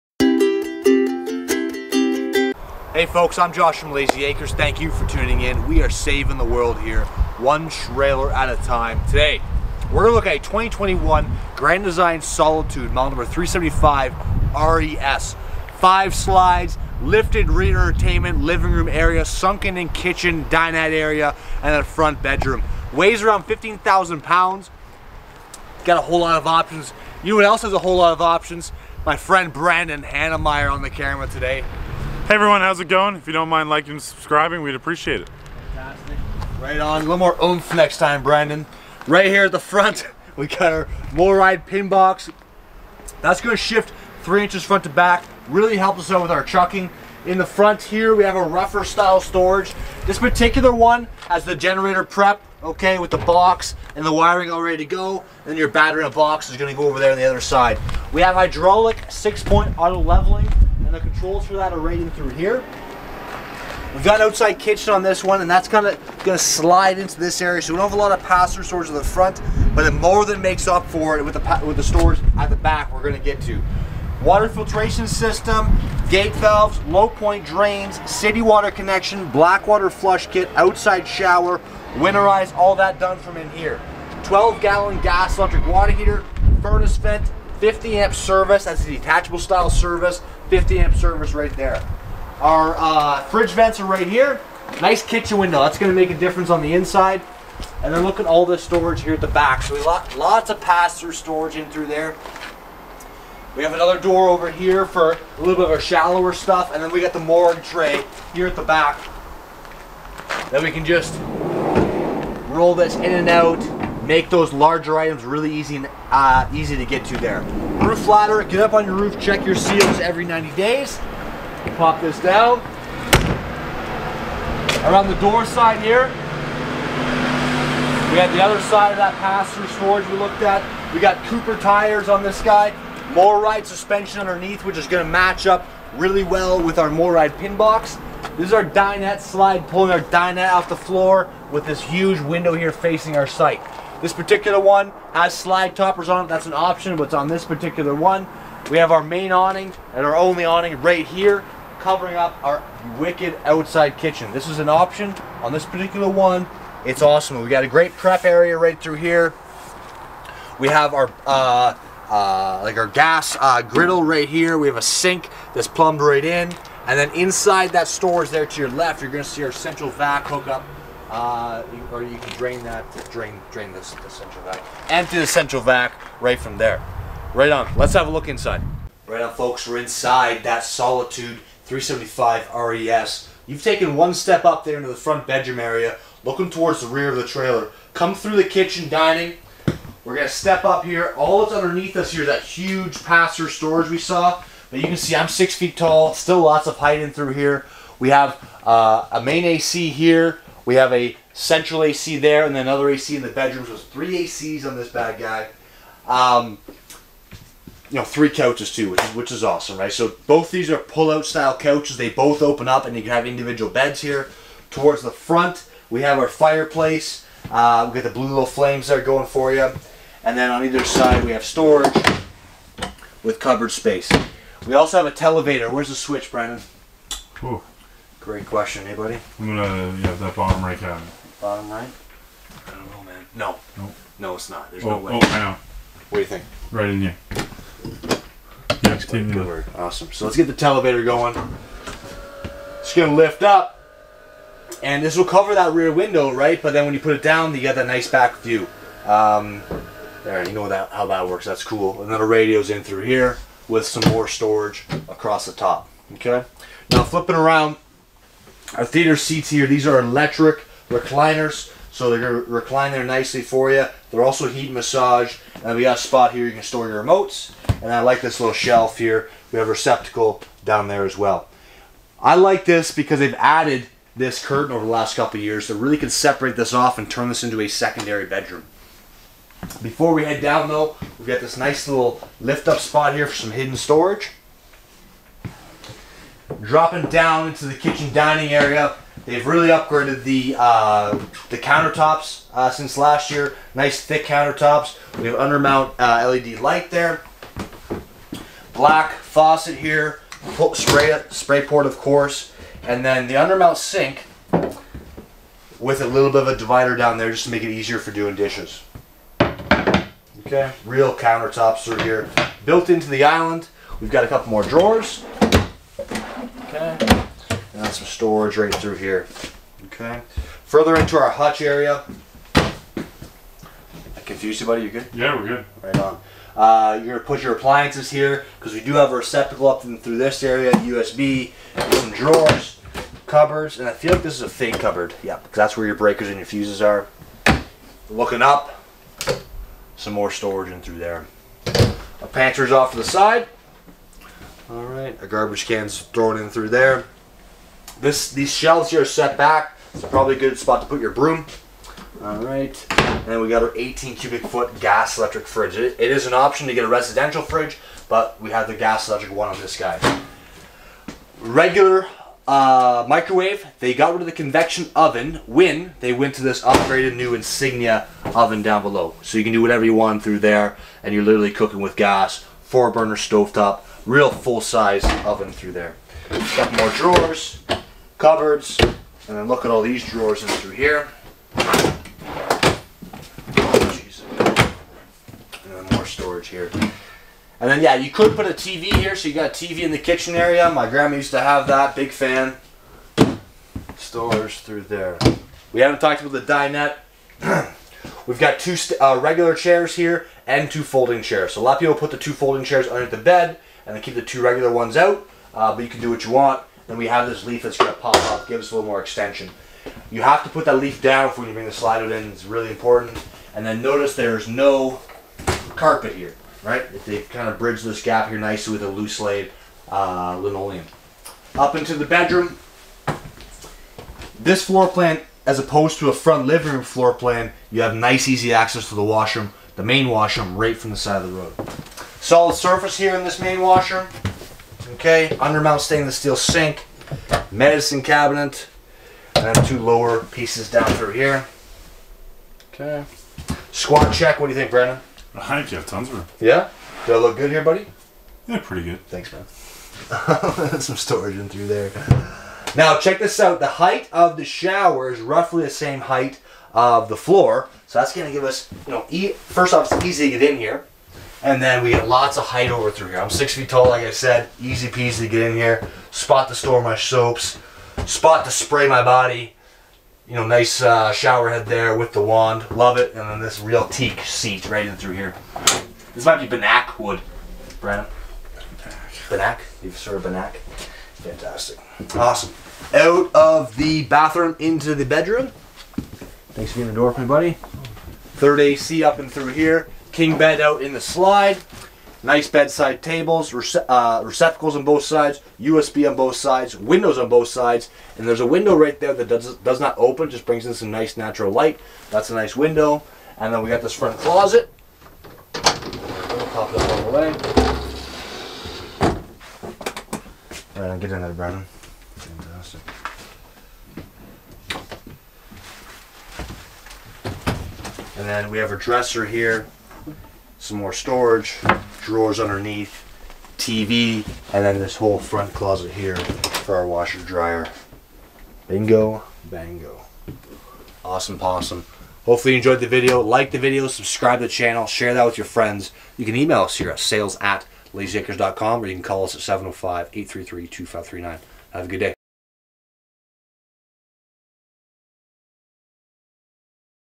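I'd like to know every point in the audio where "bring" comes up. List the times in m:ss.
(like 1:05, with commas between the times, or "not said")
6:51, 8:20.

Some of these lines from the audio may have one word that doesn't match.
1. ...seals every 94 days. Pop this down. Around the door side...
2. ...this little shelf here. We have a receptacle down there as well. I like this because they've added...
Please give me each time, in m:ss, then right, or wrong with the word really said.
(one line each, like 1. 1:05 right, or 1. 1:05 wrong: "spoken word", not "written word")
1. 1:59 wrong: "90", not "94"
2. 4:28 right.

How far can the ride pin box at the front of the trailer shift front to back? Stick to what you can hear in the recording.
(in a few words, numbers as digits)
3 inches.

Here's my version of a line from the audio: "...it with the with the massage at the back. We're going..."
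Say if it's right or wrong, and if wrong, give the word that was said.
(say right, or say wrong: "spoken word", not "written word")
wrong: "storage", not "massage".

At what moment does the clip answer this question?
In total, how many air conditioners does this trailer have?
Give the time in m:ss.
3:23.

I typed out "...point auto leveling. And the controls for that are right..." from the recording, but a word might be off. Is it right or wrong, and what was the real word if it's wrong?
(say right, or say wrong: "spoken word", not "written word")
right.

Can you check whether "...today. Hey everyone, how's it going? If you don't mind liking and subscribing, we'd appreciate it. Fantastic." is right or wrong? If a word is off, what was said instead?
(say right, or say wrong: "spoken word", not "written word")
right.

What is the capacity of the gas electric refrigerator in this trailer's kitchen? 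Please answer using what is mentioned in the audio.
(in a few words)
18 cubic feet.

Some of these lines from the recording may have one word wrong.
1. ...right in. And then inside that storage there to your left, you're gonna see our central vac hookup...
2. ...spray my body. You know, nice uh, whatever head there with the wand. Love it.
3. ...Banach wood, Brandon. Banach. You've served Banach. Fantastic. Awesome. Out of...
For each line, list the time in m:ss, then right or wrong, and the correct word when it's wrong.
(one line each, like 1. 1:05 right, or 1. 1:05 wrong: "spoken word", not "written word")
1. 2:46 right
2. 7:48 wrong: "shower", not "whatever"
3. 7:56 right.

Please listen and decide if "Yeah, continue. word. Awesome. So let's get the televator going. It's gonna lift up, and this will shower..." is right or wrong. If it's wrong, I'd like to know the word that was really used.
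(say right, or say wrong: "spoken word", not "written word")
wrong: "cover", not "shower".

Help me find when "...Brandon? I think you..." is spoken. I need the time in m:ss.
7:24.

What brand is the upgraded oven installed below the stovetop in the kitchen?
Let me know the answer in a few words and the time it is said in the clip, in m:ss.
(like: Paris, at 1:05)
Insignia, at 6:07.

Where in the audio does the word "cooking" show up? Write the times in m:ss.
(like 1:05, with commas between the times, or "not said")
6:11.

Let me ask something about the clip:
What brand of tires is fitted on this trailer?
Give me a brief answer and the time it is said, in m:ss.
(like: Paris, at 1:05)
Cooper, at 2:11.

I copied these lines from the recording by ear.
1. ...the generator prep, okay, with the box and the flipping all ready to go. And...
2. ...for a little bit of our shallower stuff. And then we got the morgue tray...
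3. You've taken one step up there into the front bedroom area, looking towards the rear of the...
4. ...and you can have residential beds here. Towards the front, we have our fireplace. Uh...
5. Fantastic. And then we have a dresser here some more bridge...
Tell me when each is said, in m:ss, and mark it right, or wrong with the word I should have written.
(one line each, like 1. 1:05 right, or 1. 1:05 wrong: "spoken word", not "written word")
1. 0:51 wrong: "wiring", not "flipping"
2. 1:44 right
3. 3:03 right
4. 3:32 wrong: "individual", not "residential"
5. 8:32 wrong: "storage", not "bridge".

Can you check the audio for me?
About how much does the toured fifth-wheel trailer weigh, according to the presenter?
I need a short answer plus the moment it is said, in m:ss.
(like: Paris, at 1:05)
15,000 pounds, at 0:23.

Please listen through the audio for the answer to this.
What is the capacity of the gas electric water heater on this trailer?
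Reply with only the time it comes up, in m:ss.
1:24.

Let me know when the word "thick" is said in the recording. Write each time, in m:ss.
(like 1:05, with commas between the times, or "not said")
4:54.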